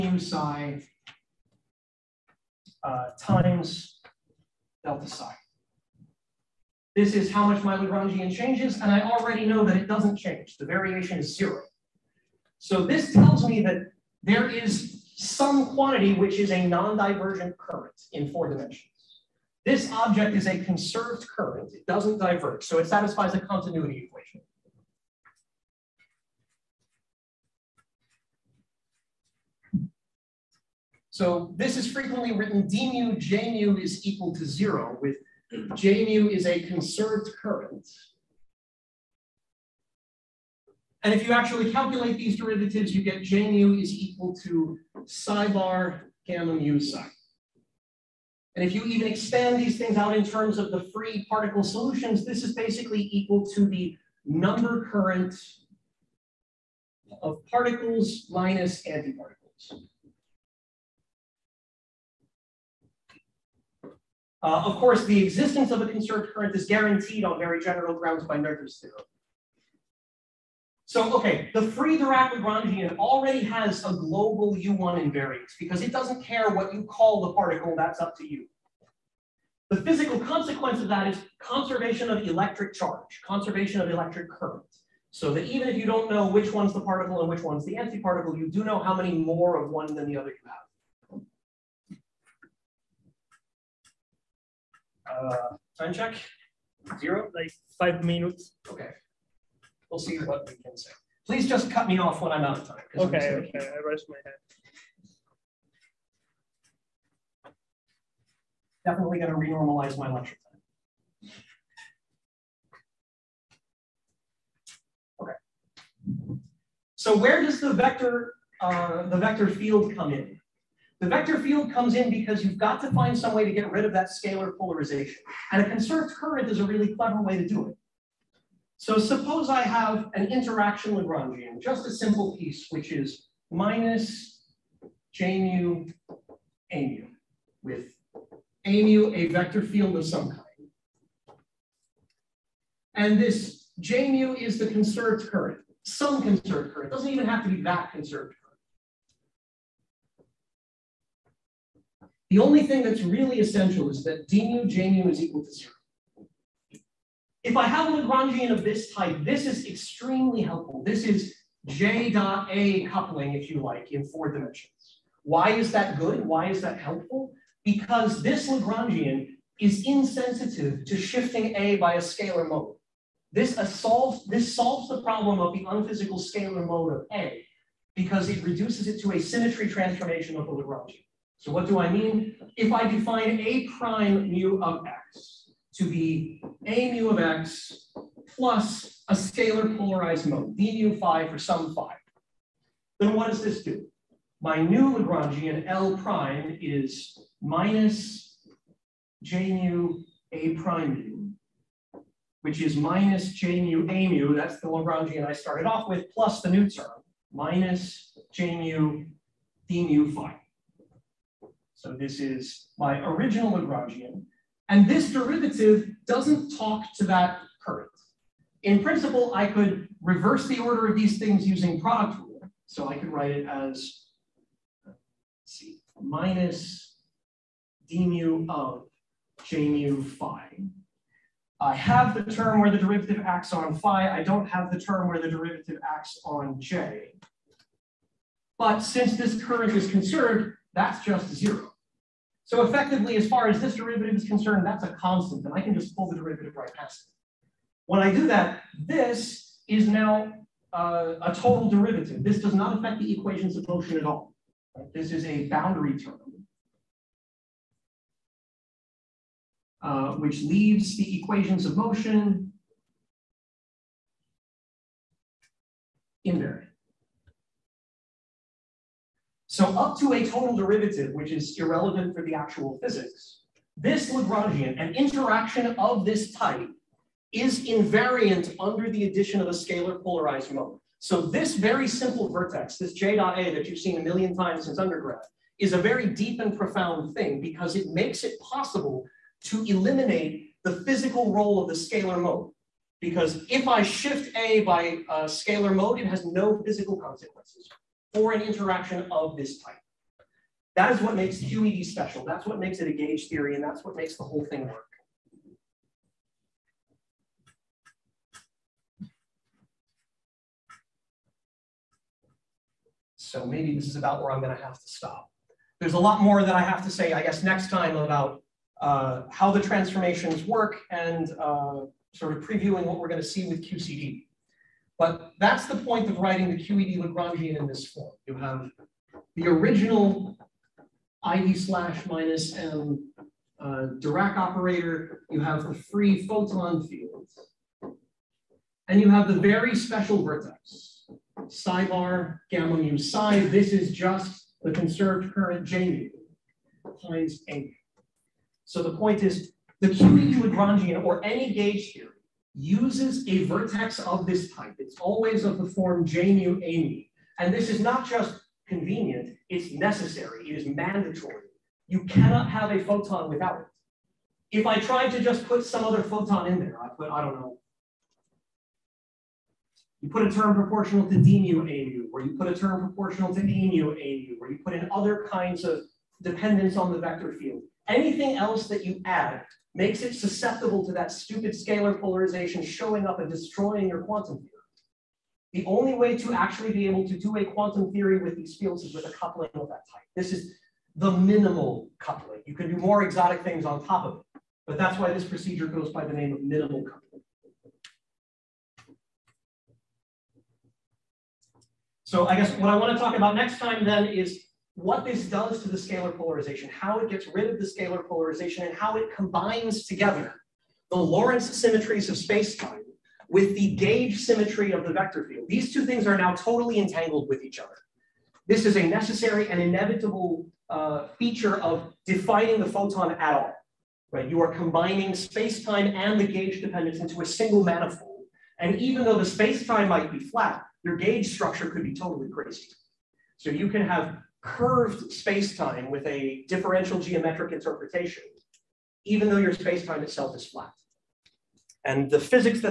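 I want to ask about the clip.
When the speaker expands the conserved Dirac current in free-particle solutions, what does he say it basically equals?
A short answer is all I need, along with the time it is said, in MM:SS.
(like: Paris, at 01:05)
number current of particles minus antiparticles, at 00:54.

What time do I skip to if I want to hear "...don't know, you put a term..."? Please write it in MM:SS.
06:07.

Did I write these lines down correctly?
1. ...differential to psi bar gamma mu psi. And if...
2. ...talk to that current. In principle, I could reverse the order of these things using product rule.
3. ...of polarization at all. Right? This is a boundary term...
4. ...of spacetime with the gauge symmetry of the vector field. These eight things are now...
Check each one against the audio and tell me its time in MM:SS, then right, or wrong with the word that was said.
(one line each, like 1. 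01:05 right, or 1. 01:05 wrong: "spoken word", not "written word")
1. 00:43 wrong: "equal", not "differential"
2. 03:36 right
3. 04:13 wrong: "motion", not "polarization"
4. 06:52 wrong: "two", not "eight".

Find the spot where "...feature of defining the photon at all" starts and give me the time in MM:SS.
07:01.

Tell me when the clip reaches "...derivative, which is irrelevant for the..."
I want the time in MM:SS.
04:30.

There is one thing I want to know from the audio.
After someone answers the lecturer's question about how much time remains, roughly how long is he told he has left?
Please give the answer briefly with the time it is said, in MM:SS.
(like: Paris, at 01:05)
5 minutes, at 01:37.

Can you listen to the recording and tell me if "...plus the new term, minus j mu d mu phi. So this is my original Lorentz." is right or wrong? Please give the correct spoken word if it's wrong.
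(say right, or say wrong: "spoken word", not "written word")
wrong: "Lagrangian", not "Lorentz".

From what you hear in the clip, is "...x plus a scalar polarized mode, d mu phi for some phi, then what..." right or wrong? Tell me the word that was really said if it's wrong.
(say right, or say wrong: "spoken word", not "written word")
right.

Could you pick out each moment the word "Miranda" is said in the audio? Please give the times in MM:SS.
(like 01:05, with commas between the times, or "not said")
not said.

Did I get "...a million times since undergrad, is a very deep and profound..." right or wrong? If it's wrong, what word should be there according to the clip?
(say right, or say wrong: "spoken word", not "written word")
right.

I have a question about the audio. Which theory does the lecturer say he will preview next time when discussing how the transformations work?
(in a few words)
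QCD.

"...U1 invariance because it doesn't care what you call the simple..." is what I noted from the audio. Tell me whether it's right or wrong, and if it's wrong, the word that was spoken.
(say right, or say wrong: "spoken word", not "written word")
wrong: "particle", not "simple".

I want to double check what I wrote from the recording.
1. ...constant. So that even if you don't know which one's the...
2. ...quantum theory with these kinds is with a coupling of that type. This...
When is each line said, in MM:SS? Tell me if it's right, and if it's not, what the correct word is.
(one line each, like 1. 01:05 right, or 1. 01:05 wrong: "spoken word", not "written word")
1. 01:24 wrong: "current", not "constant"
2. 06:27 wrong: "fields", not "kinds".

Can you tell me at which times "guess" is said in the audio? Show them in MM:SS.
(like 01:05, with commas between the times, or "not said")
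05:17, 06:42.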